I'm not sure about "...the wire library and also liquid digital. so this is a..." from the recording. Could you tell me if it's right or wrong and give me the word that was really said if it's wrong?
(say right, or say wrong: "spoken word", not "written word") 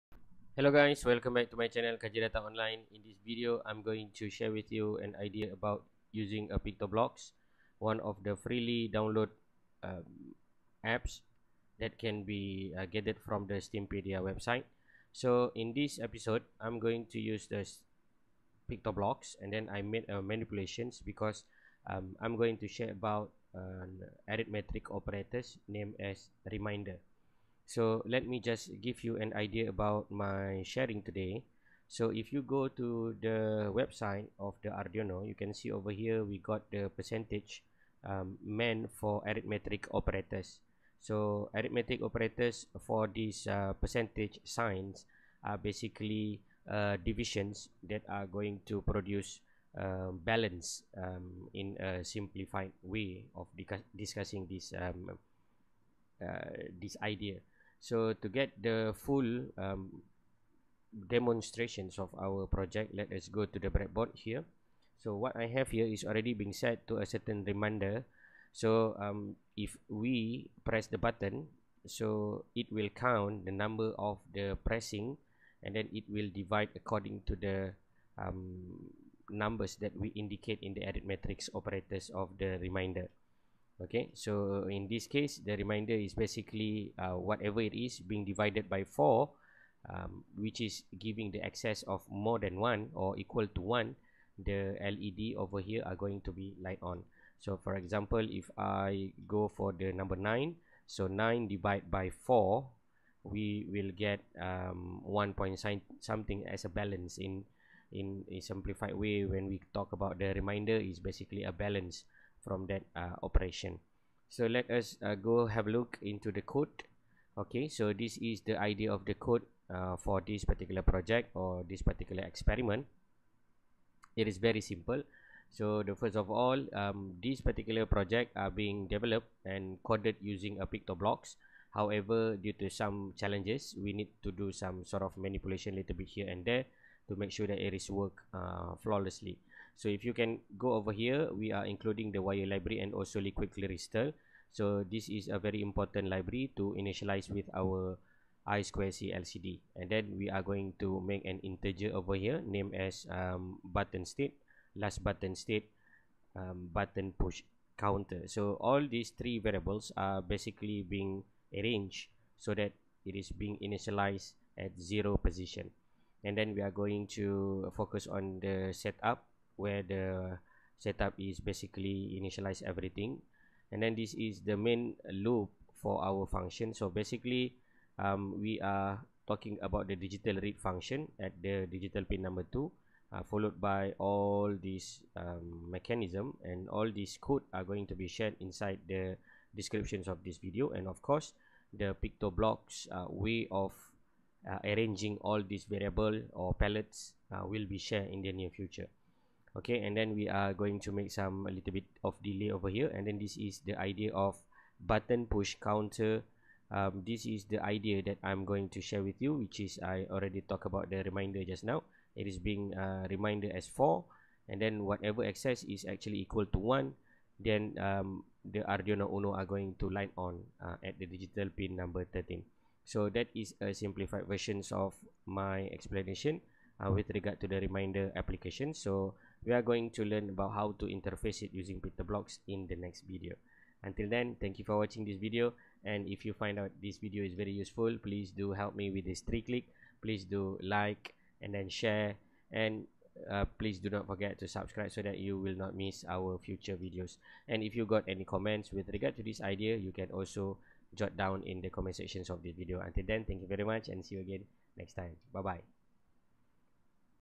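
wrong: "crystal", not "digital".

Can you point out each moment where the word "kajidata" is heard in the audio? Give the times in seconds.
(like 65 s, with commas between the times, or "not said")
1 s.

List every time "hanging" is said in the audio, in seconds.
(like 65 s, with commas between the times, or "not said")
not said.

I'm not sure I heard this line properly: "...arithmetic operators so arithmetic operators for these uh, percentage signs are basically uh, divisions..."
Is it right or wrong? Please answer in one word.
right.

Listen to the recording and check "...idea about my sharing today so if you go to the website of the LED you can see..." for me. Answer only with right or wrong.
wrong.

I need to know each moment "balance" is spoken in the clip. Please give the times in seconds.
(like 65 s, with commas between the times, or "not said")
50 s, 106 s, 111 s.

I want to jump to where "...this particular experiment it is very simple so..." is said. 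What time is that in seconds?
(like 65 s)
121 s.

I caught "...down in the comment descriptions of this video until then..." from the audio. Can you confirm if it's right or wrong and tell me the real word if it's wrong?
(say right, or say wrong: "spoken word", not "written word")
wrong: "sections", not "descriptions".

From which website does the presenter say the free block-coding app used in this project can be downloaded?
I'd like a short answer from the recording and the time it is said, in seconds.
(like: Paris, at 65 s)
STEMpedia, at 13 s.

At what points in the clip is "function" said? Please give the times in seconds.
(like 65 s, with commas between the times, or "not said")
176 s, 180 s.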